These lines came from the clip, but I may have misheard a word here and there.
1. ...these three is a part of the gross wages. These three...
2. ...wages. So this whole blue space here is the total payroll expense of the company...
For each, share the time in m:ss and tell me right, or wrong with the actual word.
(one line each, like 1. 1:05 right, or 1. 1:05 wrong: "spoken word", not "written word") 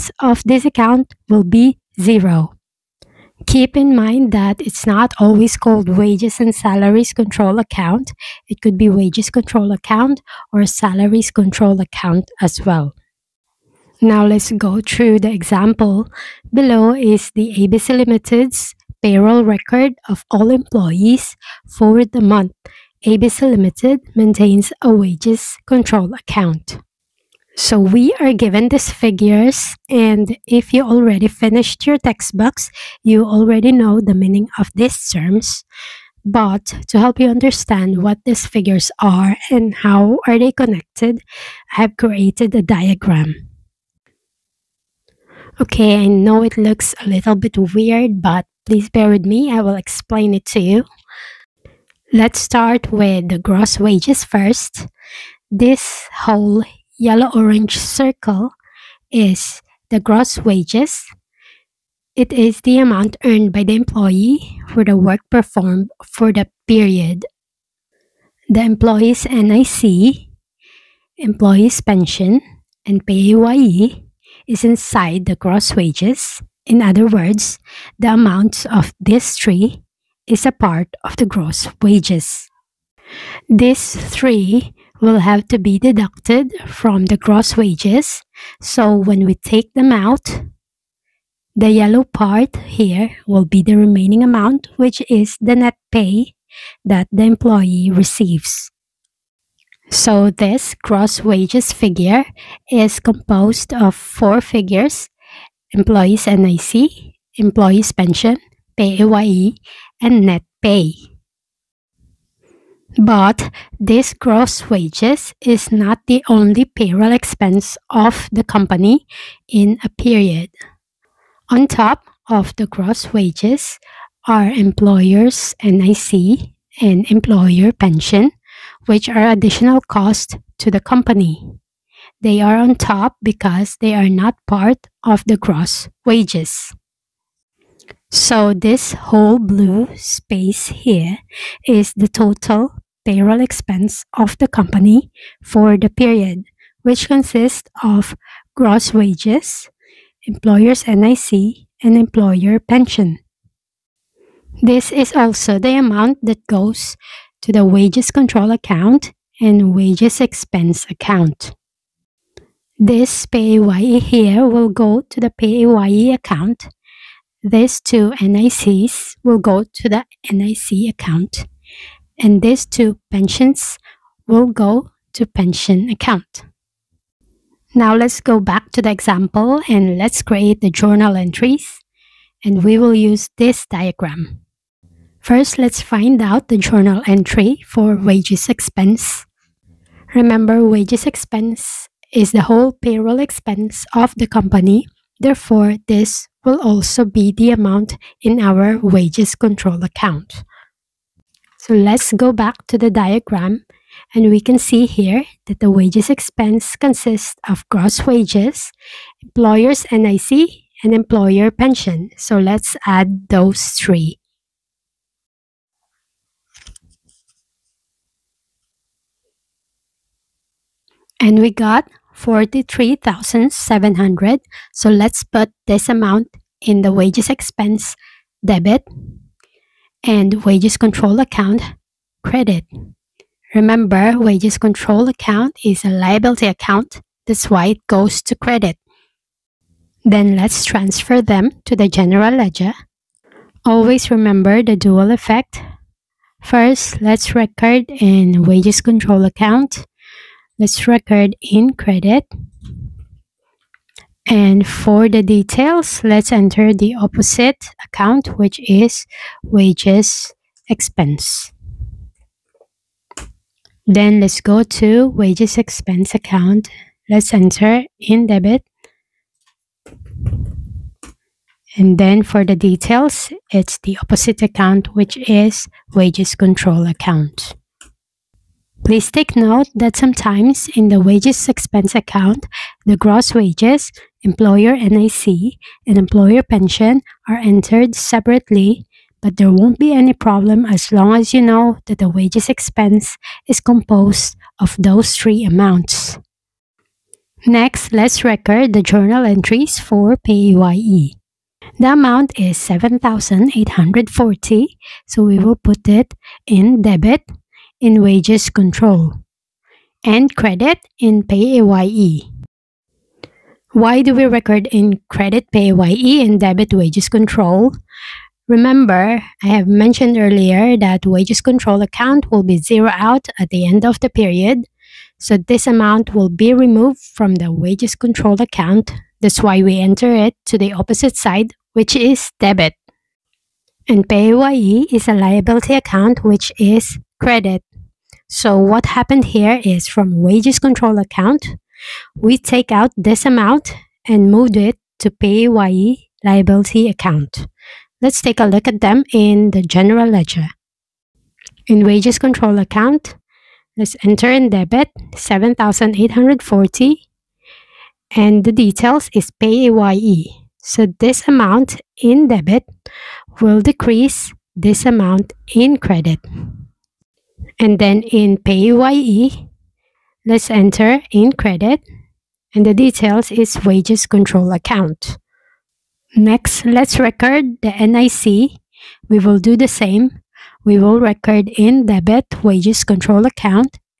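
1. 1:18 right
2. 2:16 right.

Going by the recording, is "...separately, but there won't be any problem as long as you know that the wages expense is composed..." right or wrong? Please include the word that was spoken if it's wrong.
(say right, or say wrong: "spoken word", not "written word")
right.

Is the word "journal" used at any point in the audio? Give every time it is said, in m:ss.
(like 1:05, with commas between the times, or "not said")
3:00, 3:06, 4:58.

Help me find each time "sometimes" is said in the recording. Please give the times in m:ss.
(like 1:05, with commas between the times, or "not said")
4:39.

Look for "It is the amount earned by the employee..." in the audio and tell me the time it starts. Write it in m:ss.
1:02.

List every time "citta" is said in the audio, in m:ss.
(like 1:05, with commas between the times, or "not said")
not said.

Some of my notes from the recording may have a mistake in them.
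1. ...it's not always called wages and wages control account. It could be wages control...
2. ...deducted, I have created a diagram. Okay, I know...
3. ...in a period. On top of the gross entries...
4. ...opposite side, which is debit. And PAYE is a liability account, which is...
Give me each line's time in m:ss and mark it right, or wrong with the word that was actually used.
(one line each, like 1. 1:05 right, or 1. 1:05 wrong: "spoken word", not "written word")
1. 0:04 wrong: "salaries", not "wages"
2. 0:40 wrong: "connected", not "deducted"
3. 1:59 wrong: "wages", not "entries"
4. 5:30 right.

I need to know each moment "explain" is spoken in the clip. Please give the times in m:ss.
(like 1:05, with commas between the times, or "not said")
0:49.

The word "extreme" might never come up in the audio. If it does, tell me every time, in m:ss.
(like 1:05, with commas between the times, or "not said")
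not said.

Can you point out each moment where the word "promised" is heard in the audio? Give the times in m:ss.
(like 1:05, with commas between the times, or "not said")
not said.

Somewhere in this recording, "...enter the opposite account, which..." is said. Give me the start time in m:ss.
4:16.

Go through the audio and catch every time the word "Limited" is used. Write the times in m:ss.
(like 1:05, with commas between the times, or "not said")
0:17, 0:23.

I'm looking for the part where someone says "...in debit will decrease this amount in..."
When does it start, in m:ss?
6:02.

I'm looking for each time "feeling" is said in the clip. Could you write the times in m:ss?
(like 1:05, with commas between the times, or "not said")
not said.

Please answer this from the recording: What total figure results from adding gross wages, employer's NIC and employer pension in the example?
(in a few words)
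43,700.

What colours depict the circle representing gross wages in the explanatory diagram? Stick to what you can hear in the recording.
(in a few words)
yellow orange.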